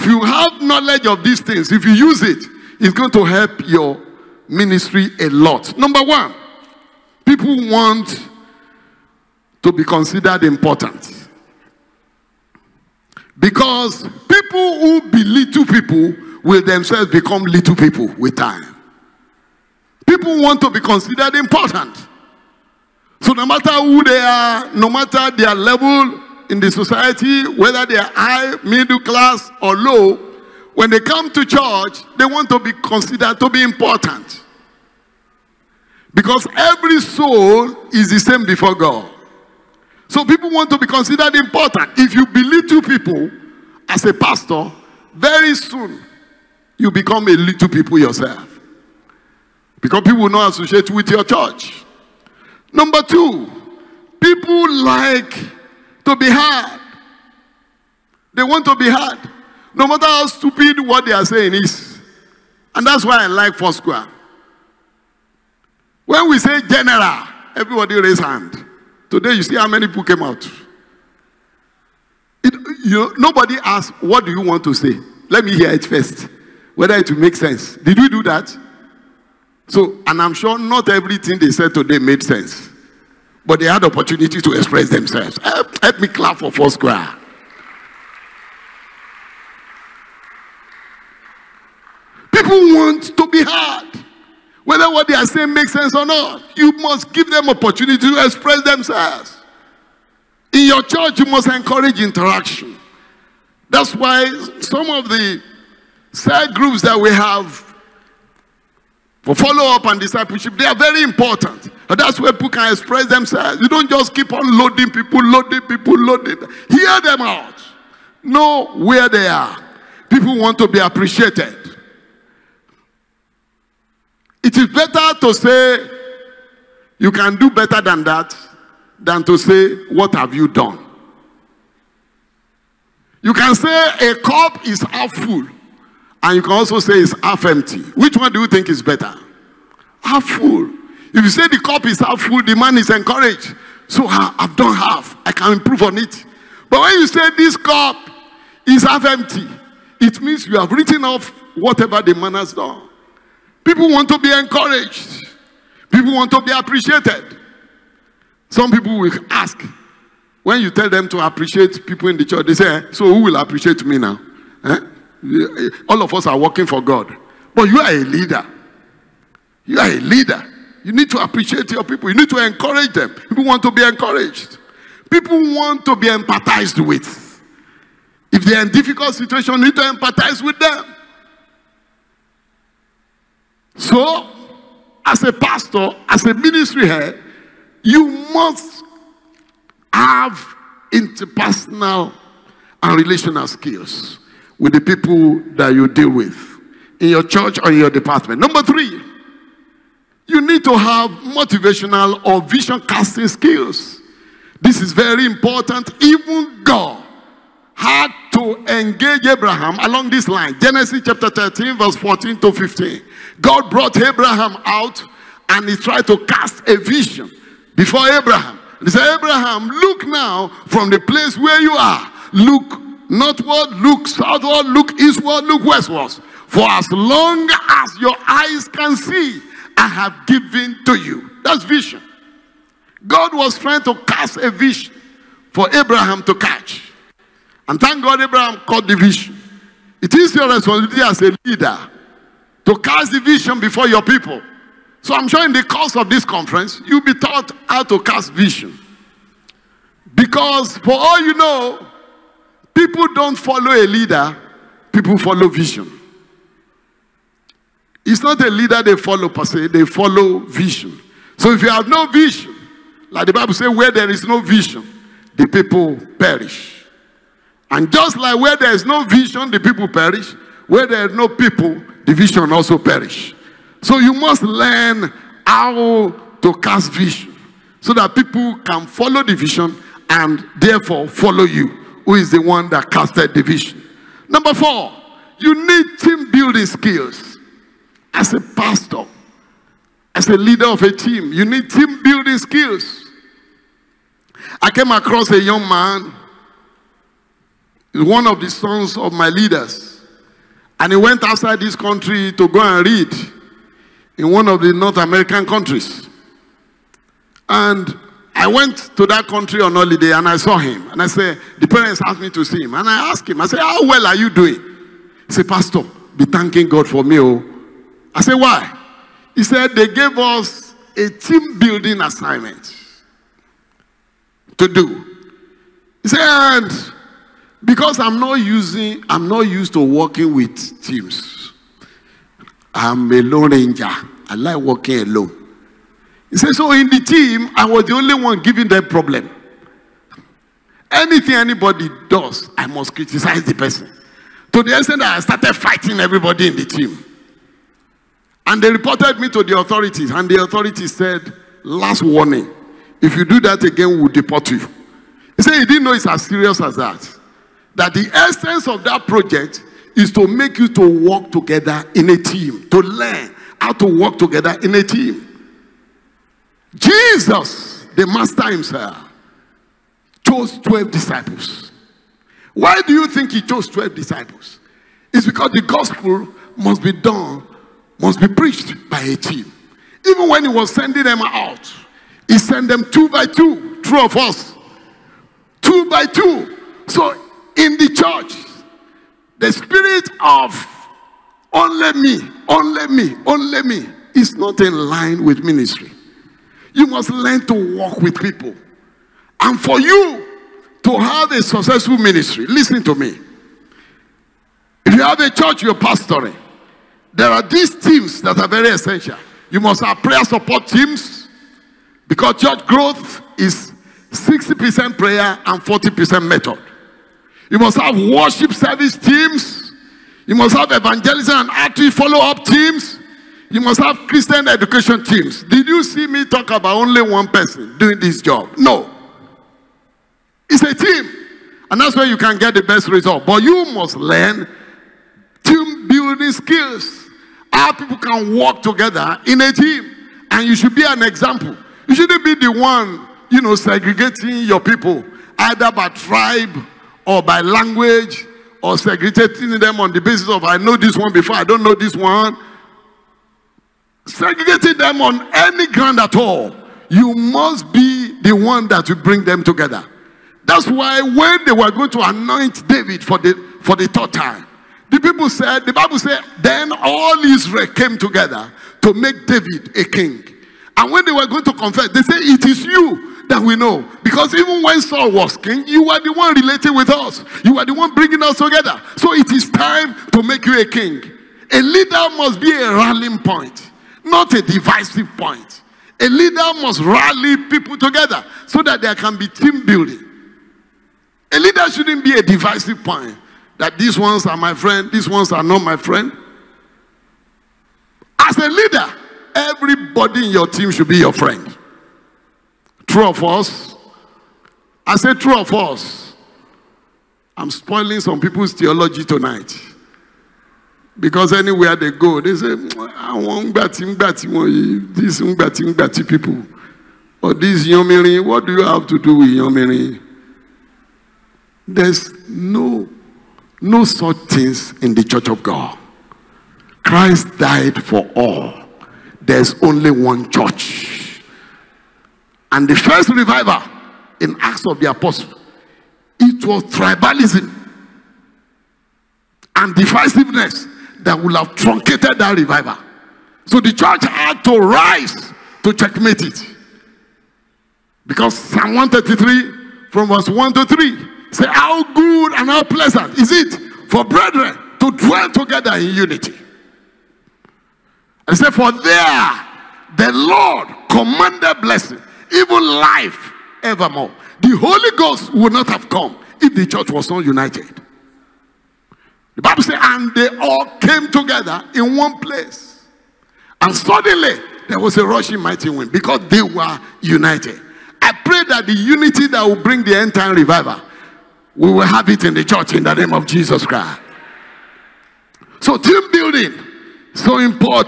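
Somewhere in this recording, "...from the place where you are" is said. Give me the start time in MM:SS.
03:40.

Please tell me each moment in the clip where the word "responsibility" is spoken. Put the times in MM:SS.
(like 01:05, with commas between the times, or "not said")
04:00.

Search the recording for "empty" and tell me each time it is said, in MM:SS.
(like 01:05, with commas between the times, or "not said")
02:17, 02:29.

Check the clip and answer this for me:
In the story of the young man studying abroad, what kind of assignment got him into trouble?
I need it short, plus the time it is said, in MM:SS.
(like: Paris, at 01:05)
Team building assignment, at 05:21.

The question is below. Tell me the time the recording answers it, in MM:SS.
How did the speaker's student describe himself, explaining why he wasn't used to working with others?
05:33.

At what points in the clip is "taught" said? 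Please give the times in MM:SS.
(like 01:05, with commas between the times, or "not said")
04:07.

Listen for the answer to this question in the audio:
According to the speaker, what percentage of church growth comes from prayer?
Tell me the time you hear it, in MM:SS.
06:54.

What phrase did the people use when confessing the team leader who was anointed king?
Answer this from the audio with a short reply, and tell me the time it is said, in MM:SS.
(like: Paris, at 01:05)
It is you that we know, at 07:52.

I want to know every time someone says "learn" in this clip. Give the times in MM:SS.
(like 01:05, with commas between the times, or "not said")
04:34, 06:02, 06:37, 07:13.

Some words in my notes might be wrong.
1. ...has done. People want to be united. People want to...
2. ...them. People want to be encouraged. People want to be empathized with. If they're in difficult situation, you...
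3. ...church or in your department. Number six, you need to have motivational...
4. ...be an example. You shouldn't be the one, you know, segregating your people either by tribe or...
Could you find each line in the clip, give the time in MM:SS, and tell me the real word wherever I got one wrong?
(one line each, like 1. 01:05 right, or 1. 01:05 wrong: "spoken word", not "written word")
1. 02:32 wrong: "encouraged", not "united"
2. 02:52 right
3. 03:17 wrong: "three", not "six"
4. 07:20 right.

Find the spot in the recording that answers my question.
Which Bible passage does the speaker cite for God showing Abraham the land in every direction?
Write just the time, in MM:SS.
03:30.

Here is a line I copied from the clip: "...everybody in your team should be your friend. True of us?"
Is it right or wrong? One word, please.
right.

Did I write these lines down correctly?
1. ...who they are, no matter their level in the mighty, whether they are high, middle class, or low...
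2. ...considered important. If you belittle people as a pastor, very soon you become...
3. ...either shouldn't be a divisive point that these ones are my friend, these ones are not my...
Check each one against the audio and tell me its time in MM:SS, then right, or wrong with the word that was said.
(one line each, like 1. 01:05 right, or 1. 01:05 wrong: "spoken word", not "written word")
1. 00:23 wrong: "society", not "mighty"
2. 00:40 right
3. 08:11 wrong: "leader", not "either".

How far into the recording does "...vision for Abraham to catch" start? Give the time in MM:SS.
03:54.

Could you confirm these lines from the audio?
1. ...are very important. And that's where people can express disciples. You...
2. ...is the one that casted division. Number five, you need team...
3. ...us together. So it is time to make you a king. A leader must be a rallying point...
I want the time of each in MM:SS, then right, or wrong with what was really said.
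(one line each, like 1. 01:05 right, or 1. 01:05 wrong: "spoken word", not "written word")
1. 01:50 wrong: "themselves", not "disciples"
2. 04:42 wrong: "four", not "five"
3. 07:58 right.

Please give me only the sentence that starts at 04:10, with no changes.
Because for all you know, people don't follow a leader, people follow vision.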